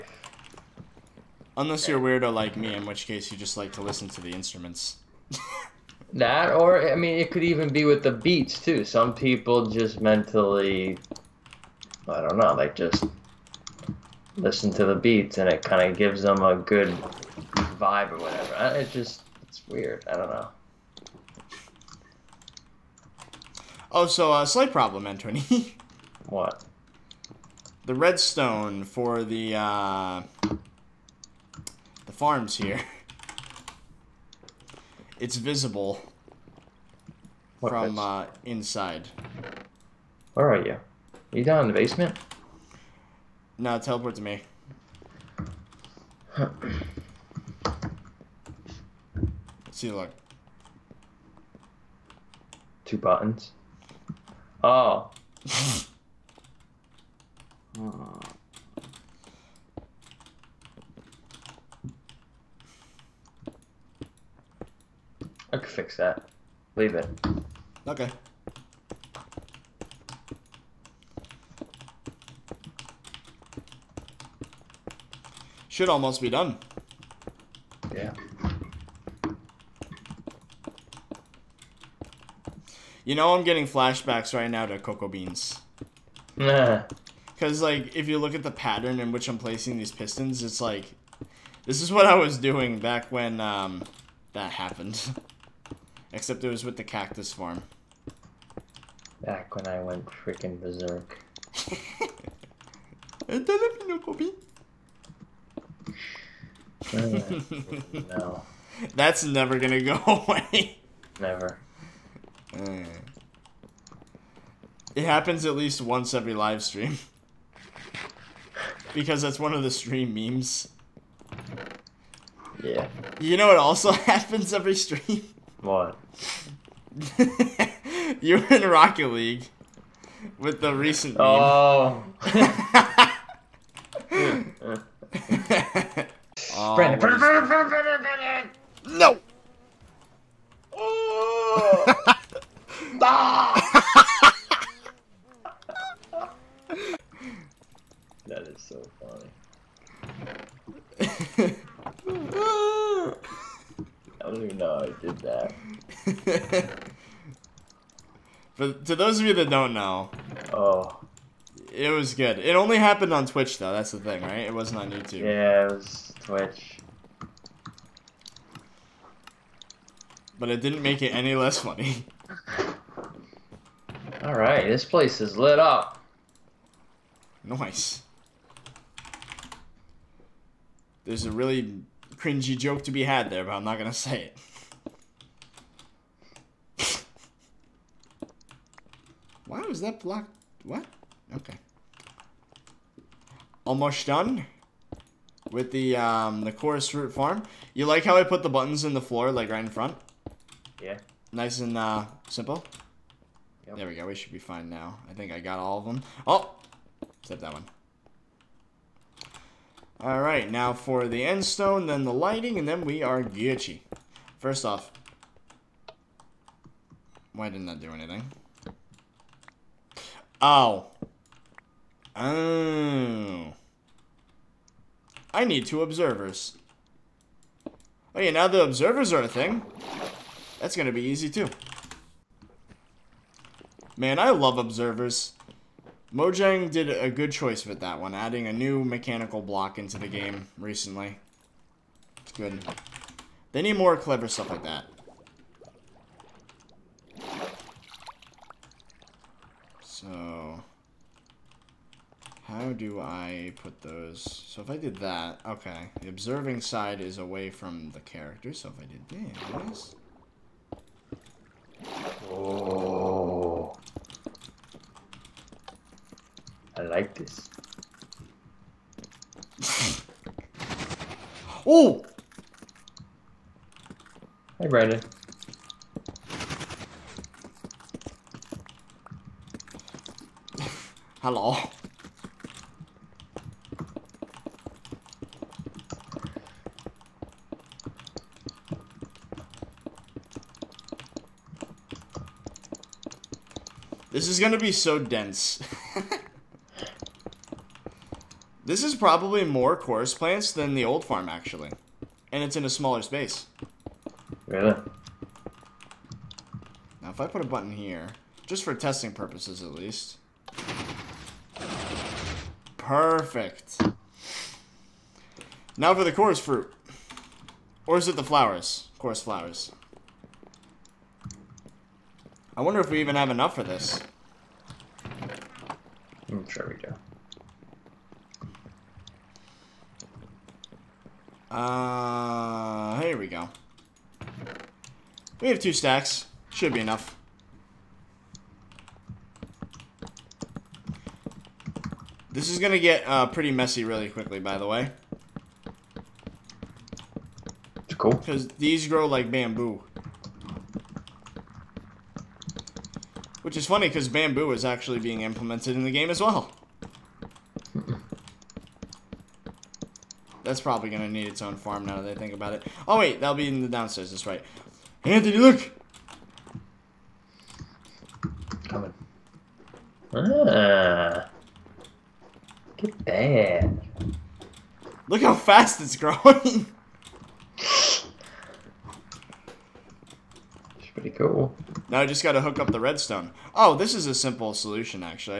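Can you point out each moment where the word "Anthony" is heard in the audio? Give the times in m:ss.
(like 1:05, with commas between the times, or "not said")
0:25, 6:05.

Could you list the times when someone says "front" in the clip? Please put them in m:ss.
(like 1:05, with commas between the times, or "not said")
3:19.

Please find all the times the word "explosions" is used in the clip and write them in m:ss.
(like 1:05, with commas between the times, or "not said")
not said.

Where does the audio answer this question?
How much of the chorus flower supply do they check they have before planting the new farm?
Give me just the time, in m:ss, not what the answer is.
5:35.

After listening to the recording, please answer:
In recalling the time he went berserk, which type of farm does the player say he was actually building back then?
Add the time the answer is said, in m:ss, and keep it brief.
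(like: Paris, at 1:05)
cactus farm, at 1:36.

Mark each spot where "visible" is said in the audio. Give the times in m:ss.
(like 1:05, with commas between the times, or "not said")
0:35.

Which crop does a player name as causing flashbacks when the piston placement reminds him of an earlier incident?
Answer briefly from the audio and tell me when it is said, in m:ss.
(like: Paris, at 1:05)
Cocoa Beans, at 1:24.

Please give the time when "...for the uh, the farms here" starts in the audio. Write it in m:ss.
0:28.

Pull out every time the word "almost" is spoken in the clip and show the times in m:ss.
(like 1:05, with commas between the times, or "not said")
1:15, 3:13.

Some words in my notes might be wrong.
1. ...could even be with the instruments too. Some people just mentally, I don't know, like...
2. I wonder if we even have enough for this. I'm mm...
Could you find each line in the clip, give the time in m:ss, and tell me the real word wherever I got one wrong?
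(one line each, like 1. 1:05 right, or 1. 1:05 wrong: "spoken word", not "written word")
1. 0:07 wrong: "beats", not "instruments"
2. 5:22 right.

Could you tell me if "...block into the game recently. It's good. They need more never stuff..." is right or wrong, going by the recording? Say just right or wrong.
wrong.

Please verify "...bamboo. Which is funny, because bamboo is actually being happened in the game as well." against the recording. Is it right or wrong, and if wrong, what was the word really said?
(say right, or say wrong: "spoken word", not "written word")
wrong: "implemented", not "happened".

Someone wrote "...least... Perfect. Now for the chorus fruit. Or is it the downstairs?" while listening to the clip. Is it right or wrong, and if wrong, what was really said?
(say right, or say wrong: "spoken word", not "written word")
wrong: "flowers", not "downstairs".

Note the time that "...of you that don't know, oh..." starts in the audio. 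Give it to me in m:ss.
2:39.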